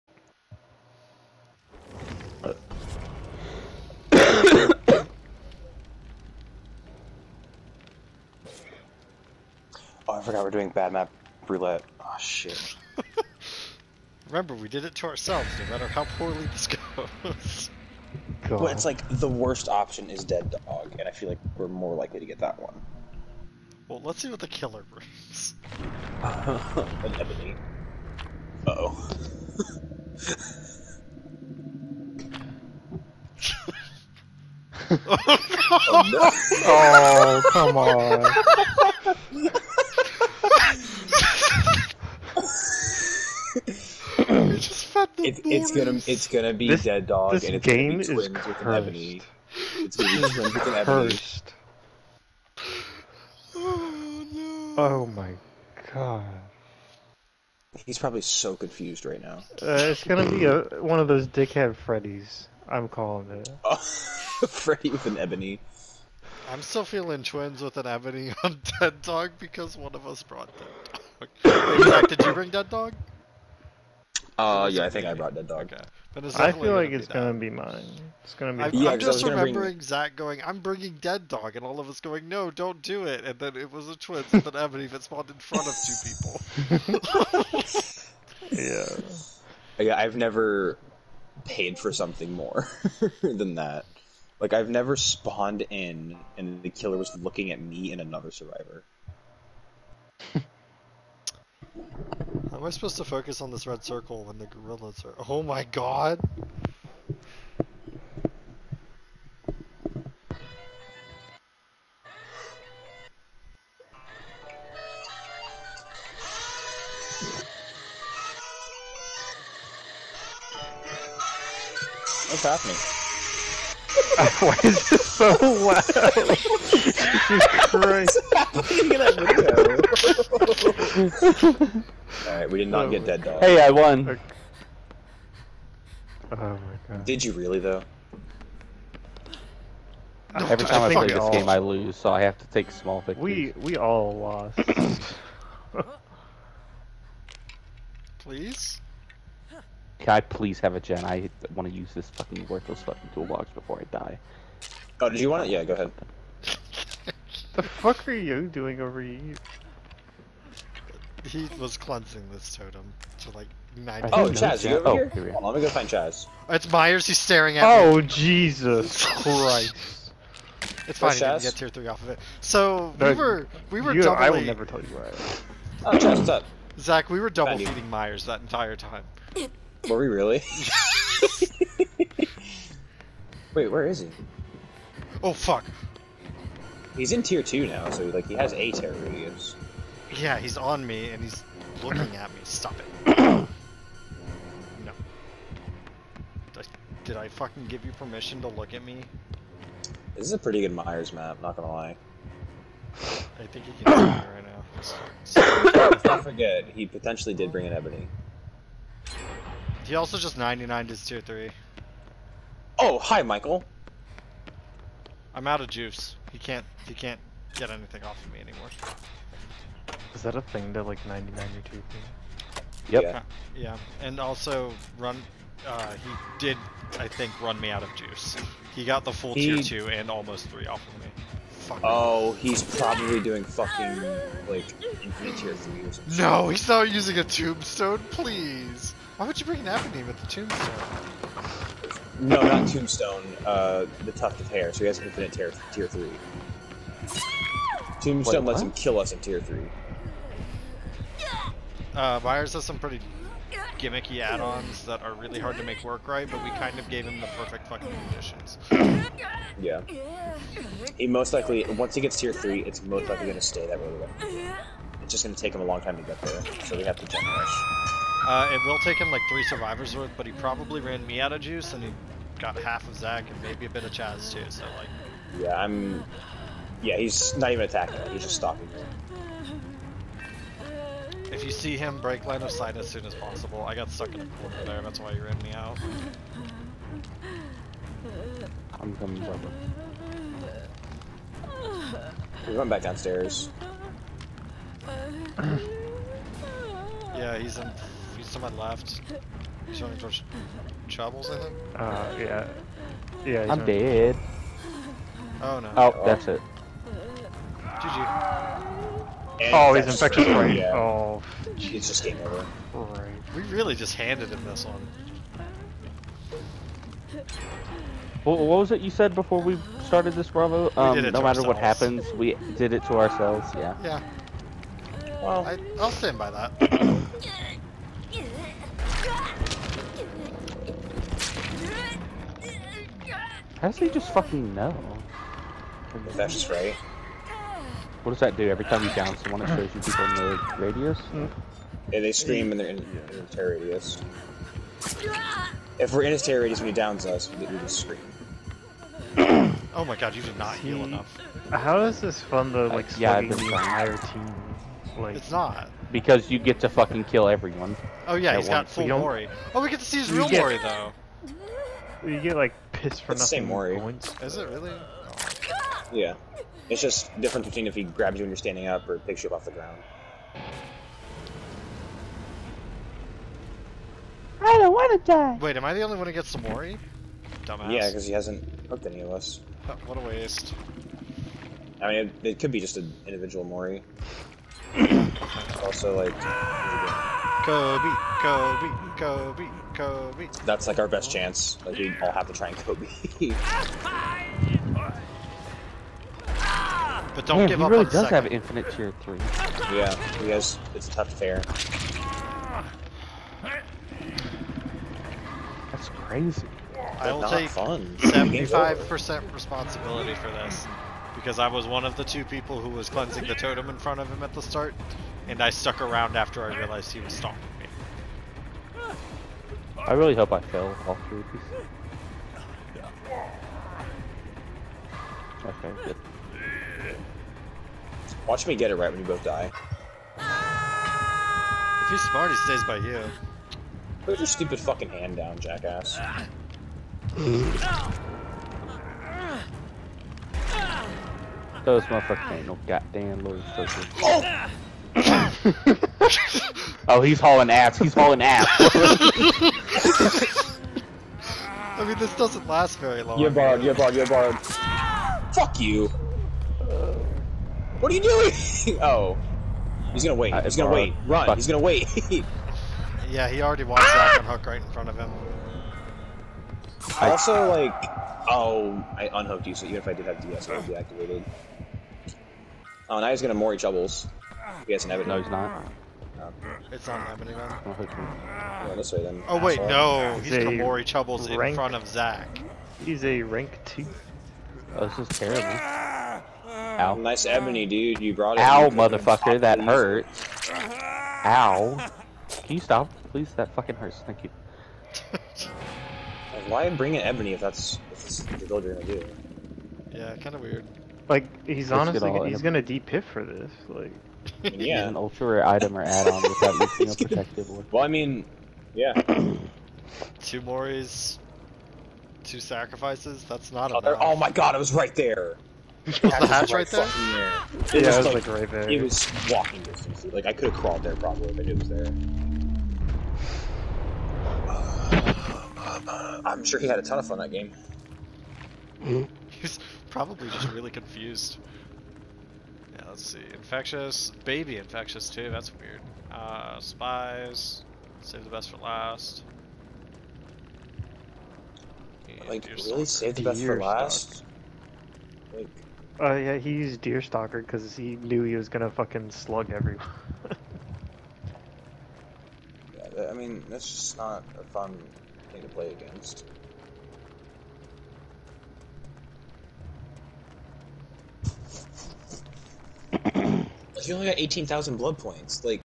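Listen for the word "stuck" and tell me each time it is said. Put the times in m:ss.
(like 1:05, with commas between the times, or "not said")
4:43, 6:55.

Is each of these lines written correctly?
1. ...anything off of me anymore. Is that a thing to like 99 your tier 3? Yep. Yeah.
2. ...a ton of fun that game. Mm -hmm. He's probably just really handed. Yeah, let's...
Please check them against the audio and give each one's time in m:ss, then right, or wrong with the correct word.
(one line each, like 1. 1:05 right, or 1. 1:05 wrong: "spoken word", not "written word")
1. 3:37 right
2. 8:46 wrong: "confused", not "handed".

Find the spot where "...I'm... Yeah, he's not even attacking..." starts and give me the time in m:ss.
4:35.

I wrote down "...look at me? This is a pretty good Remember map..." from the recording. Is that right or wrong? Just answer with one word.
wrong.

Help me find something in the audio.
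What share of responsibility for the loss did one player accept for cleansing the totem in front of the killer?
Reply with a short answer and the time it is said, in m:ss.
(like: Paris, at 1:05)
75%, at 6:48.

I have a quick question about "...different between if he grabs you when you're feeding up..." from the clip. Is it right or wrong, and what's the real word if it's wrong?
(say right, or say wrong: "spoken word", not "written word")
wrong: "standing", not "feeding".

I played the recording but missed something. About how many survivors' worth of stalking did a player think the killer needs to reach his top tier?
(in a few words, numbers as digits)
3.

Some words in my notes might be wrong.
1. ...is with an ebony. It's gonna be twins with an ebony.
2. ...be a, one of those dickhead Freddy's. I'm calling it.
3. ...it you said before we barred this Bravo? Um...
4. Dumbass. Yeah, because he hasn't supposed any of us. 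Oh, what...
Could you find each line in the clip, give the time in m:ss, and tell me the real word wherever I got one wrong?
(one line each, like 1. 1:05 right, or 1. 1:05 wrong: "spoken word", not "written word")
1. 0:48 right
2. 1:00 right
3. 5:18 wrong: "started", not "barred"
4. 6:17 wrong: "hooked", not "supposed".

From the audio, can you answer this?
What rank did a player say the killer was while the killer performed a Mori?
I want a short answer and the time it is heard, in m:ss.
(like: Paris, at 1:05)
Rank 2, at 8:03.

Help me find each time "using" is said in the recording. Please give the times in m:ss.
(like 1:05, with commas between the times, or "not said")
3:56, 8:26.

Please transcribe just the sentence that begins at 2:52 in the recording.
So, no, we were, we were you, doubly...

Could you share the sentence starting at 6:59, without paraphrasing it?
I really hope I fail all three of these.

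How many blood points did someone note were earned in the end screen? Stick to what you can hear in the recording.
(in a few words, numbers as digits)
18,000.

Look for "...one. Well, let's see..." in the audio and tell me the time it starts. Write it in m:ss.
0:22.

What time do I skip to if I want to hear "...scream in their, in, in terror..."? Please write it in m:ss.
5:42.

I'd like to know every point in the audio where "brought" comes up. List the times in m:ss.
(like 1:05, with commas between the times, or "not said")
1:10, 1:15, 8:08.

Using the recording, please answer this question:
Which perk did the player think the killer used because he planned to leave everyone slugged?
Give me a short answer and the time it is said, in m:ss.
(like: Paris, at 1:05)
Deerstalker, at 9:06.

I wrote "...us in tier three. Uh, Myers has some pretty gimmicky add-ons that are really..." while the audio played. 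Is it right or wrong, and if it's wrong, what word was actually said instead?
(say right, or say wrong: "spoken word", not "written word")
right.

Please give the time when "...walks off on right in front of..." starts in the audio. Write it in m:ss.
7:43.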